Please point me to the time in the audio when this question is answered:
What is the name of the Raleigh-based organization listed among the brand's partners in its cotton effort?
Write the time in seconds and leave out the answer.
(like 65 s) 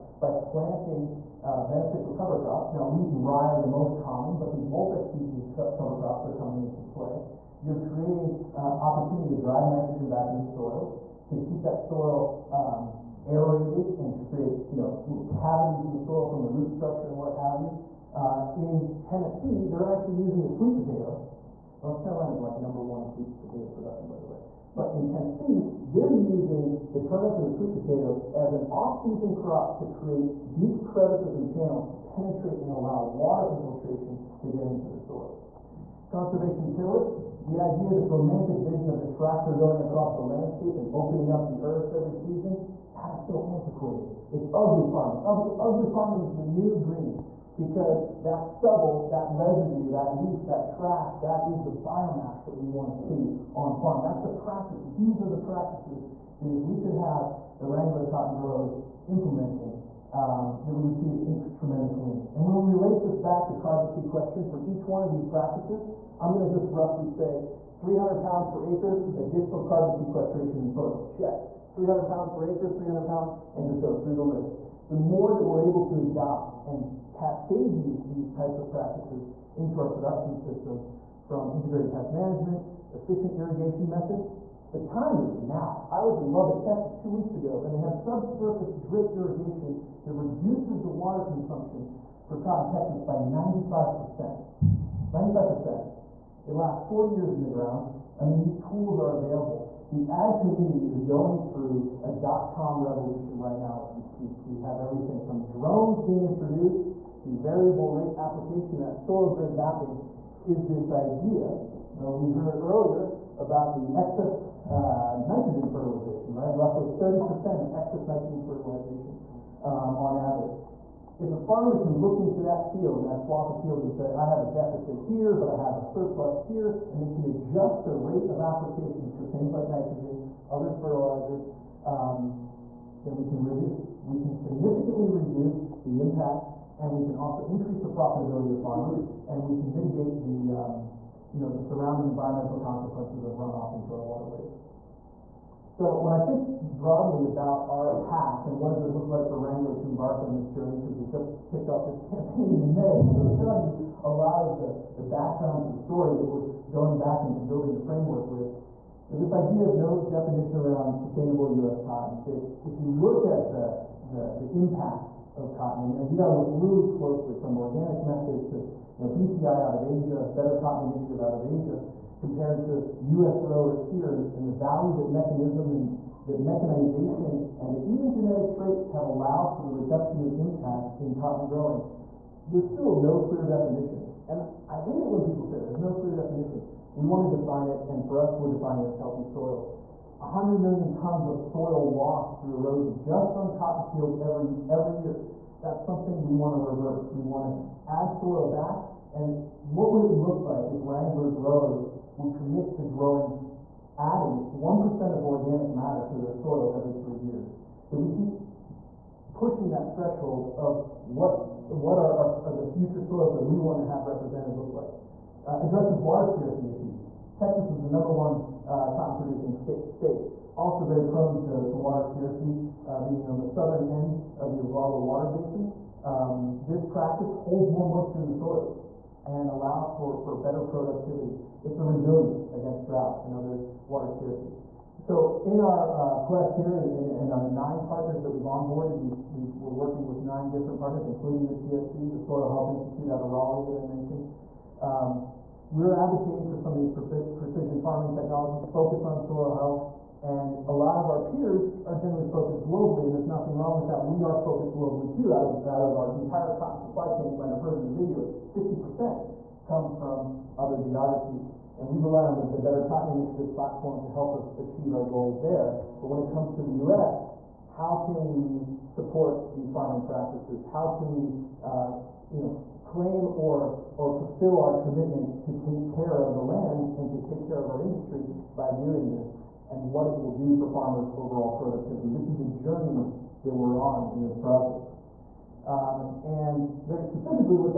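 242 s.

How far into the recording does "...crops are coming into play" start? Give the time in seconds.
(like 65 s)
6 s.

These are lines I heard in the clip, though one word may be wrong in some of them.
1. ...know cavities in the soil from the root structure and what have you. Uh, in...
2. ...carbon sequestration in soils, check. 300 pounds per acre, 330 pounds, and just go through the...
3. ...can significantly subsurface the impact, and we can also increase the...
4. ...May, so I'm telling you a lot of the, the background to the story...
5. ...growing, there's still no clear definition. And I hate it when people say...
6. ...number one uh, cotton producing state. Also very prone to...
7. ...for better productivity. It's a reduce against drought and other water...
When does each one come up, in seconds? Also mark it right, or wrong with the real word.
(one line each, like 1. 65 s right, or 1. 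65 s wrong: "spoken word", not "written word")
1. 14 s right
2. 69 s wrong: "300", not "330"
3. 134 s wrong: "reduce", not "subsurface"
4. 152 s right
5. 181 s right
6. 217 s right
7. 230 s wrong: "resilience", not "reduce".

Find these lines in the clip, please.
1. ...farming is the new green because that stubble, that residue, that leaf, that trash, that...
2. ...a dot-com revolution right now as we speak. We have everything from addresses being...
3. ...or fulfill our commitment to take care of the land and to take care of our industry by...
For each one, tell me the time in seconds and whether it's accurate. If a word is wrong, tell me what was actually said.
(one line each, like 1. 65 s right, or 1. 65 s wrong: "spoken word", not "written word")
1. 45 s right
2. 102 s wrong: "drones", not "addresses"
3. 273 s right.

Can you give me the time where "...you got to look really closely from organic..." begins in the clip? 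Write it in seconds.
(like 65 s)
166 s.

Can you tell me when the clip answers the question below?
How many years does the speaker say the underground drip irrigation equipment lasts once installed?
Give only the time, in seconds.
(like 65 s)
96 s.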